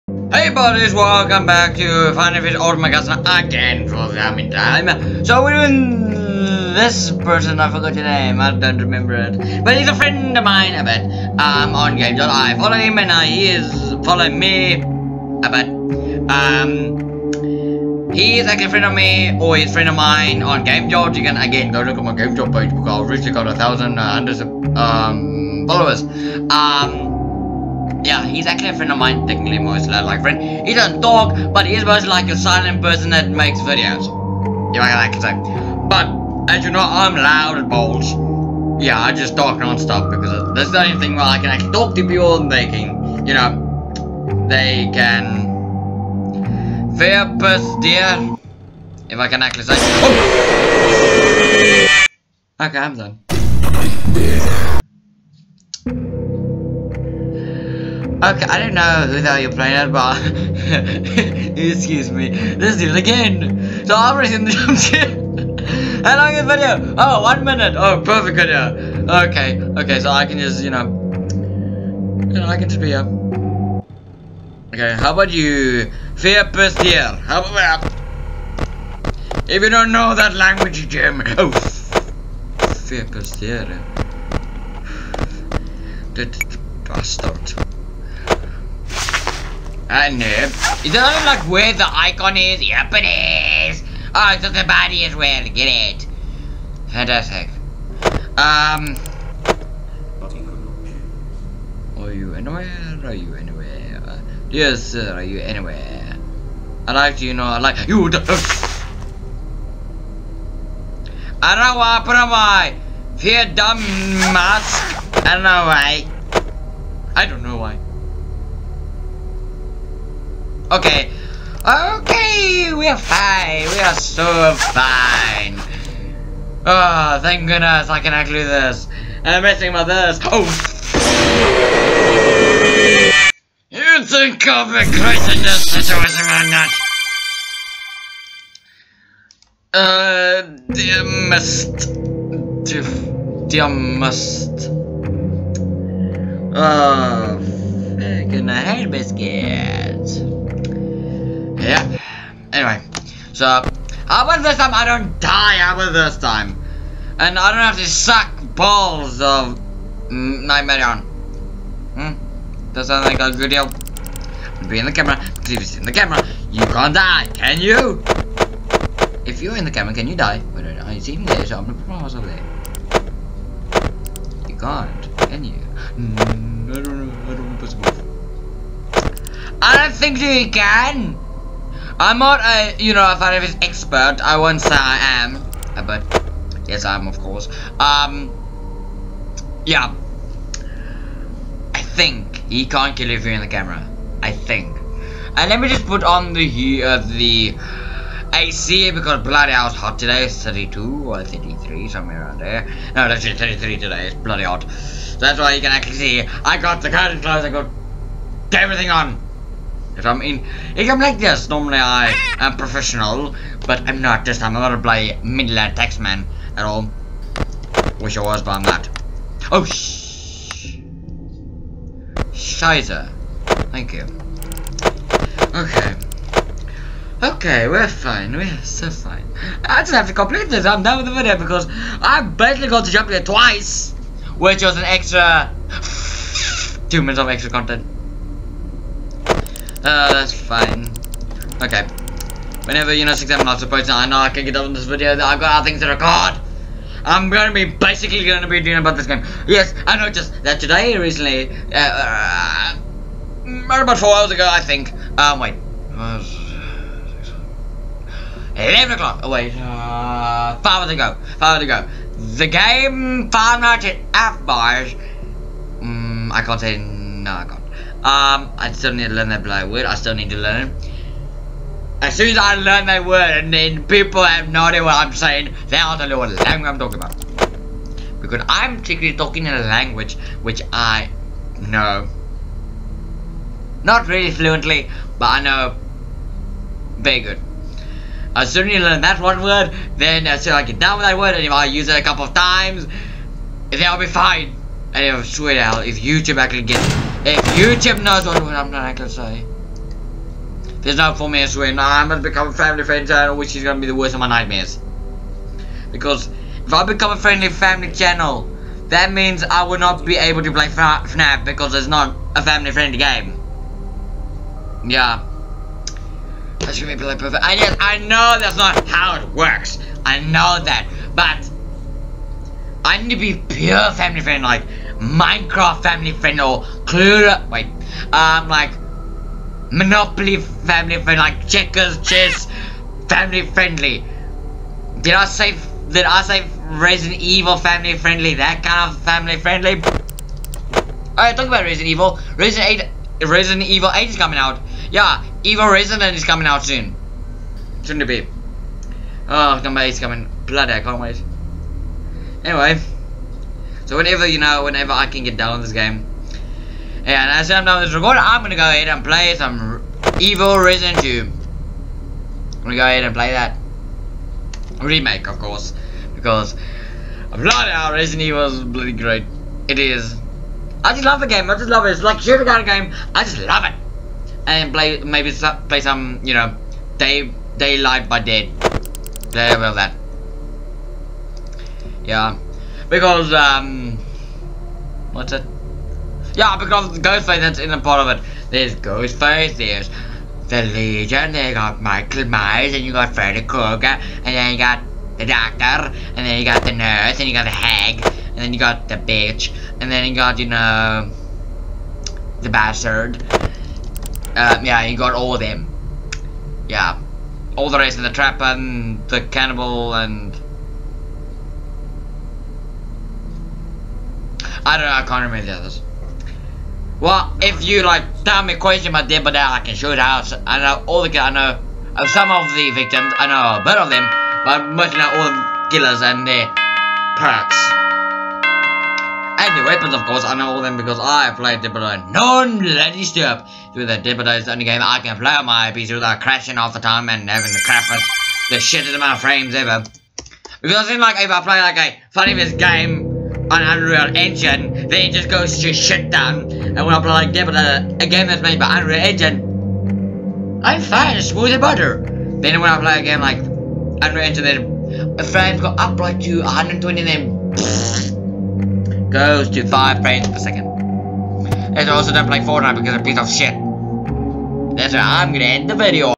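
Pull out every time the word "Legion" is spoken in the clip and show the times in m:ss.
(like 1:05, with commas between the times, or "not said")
6:30.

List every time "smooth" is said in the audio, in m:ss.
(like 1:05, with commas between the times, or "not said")
7:31.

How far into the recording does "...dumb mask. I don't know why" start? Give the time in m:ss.
1:53.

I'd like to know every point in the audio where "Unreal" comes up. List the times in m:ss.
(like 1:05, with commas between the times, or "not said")
7:23, 7:28, 7:33.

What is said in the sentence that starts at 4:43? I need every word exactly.
Not really fluently, but I know very good.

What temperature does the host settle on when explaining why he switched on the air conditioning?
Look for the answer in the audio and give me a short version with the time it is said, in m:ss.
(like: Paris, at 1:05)
33, at 3:23.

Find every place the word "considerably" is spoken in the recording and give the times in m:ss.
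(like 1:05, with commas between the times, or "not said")
not said.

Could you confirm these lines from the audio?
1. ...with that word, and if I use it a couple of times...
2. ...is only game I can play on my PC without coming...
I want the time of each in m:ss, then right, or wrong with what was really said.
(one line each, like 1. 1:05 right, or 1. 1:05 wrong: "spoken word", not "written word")
1. 4:50 right
2. 7:14 wrong: "crashing", not "coming".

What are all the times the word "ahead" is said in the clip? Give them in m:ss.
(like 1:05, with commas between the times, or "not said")
5:58, 6:02.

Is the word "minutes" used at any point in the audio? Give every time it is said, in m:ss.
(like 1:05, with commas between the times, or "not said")
1:07, 3:57, 5:01.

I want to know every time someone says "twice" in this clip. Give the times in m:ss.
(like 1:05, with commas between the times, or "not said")
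3:53.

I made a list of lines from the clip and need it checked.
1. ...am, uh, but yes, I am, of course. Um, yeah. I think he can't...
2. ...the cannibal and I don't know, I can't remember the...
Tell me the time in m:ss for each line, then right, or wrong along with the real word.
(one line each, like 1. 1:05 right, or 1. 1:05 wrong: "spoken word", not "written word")
1. 3:05 right
2. 6:49 right.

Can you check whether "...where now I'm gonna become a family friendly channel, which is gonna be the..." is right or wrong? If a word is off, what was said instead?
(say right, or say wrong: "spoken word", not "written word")
right.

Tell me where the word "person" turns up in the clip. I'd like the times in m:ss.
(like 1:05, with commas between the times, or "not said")
0:07, 0:32.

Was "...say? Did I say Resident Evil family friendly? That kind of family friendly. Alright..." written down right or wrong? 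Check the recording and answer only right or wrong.
right.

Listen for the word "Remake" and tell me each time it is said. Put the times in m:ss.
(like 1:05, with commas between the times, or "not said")
6:04.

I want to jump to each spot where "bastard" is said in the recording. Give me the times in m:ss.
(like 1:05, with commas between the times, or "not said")
1:26, 6:42.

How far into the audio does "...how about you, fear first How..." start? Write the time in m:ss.
1:15.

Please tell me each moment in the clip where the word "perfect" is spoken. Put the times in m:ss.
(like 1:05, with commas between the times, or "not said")
1:08, 5:17.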